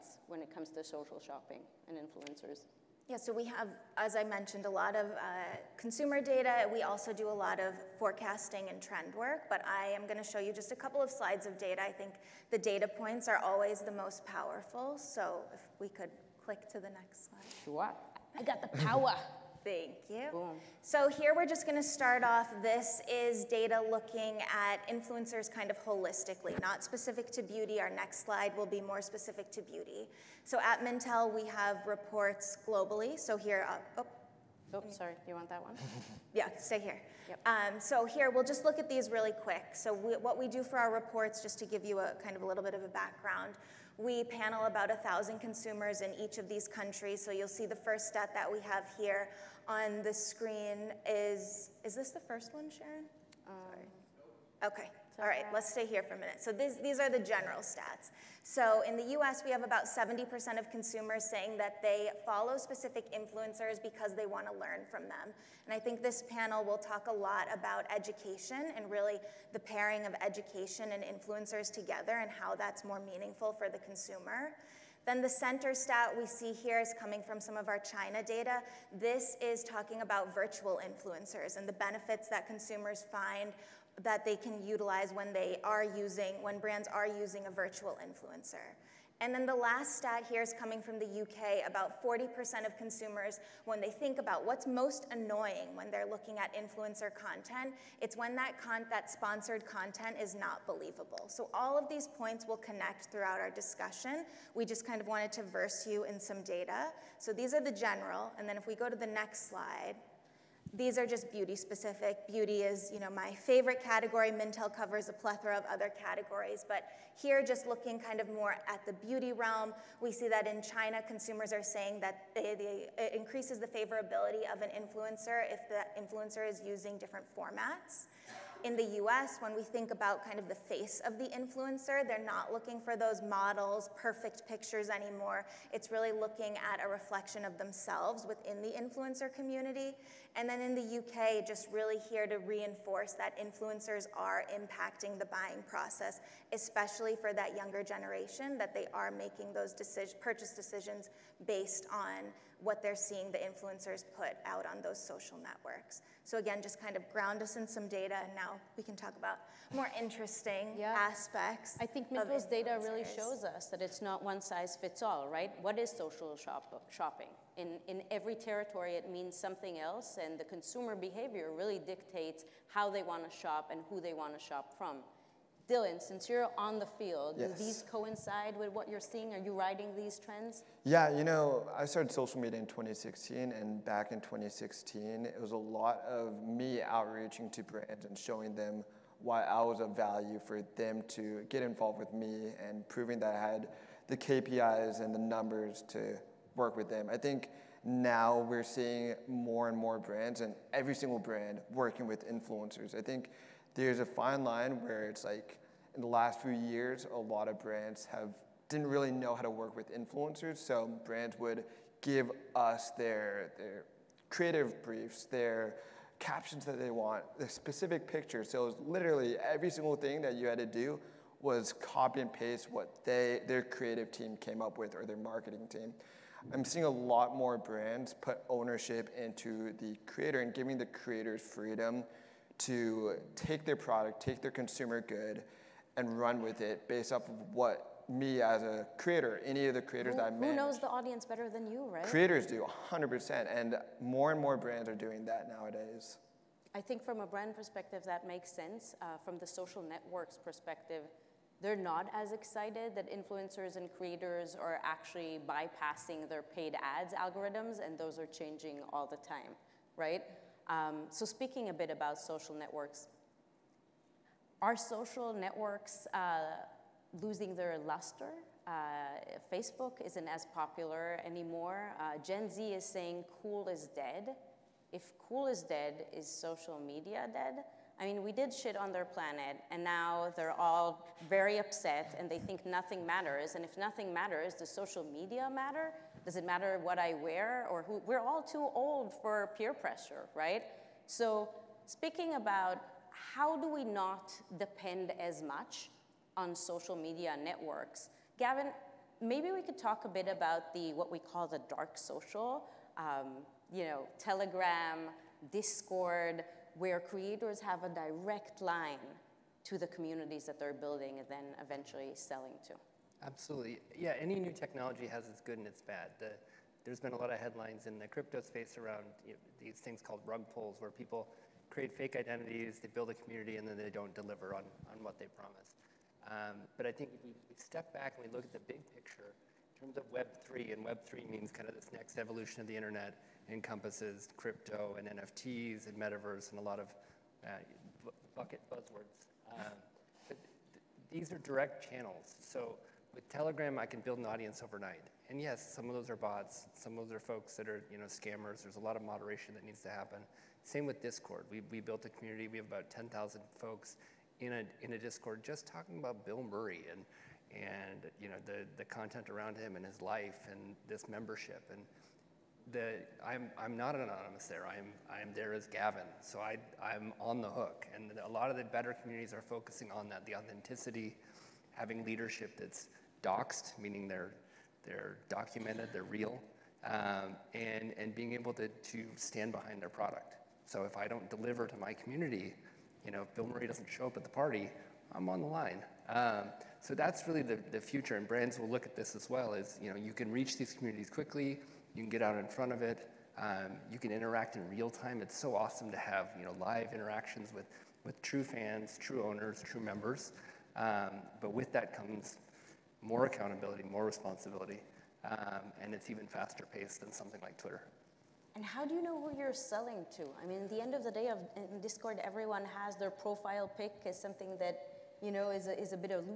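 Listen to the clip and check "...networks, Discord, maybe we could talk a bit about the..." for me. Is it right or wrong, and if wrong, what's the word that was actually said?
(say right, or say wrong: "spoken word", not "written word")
wrong: "Gavin", not "Discord".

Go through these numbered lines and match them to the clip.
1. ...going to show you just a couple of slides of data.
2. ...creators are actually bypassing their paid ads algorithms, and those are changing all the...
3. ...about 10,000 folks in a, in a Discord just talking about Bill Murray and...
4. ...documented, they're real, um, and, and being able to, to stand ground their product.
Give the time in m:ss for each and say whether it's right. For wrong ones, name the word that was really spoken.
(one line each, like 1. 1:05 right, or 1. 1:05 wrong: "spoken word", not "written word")
1. 0:10 right
2. 4:13 right
3. 5:52 right
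4. 6:15 wrong: "behind", not "ground".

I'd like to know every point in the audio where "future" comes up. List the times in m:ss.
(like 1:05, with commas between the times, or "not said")
6:27.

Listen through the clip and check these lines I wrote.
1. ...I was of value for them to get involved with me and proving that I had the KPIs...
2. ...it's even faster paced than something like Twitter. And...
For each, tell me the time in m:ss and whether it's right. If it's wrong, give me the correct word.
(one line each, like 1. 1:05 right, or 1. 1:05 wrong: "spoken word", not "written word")
1. 3:09 right
2. 6:45 right.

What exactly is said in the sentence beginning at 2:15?
It's really looking at a reflection of themselves within the influencer community.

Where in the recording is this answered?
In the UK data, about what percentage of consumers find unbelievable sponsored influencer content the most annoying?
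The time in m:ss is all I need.
1:32.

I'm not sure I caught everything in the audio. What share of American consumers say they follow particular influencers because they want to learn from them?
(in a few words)
70%.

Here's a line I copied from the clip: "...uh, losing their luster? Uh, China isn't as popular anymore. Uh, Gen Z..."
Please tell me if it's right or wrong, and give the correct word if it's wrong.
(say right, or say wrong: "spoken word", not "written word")
wrong: "Facebook", not "China".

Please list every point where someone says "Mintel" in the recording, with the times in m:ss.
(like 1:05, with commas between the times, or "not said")
0:30, 1:54, 2:42.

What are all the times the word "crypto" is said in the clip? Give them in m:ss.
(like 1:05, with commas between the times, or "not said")
5:18, 5:34.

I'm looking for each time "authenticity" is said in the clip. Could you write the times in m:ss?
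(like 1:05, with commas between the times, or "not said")
6:10.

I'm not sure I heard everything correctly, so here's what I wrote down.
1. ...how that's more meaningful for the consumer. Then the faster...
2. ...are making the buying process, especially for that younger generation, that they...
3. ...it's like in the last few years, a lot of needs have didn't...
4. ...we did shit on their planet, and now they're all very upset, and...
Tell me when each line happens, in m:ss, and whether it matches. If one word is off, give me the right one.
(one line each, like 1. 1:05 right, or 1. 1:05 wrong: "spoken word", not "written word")
1. 1:12 wrong: "center", not "faster"
2. 2:24 wrong: "impacting", not "making"
3. 3:25 wrong: "brands", not "needs"
4. 4:38 right.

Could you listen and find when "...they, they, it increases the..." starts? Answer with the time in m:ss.
2:02.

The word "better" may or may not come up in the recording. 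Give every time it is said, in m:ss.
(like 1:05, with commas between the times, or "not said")
4:01, 6:08.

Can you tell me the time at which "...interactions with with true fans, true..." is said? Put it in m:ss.
6:36.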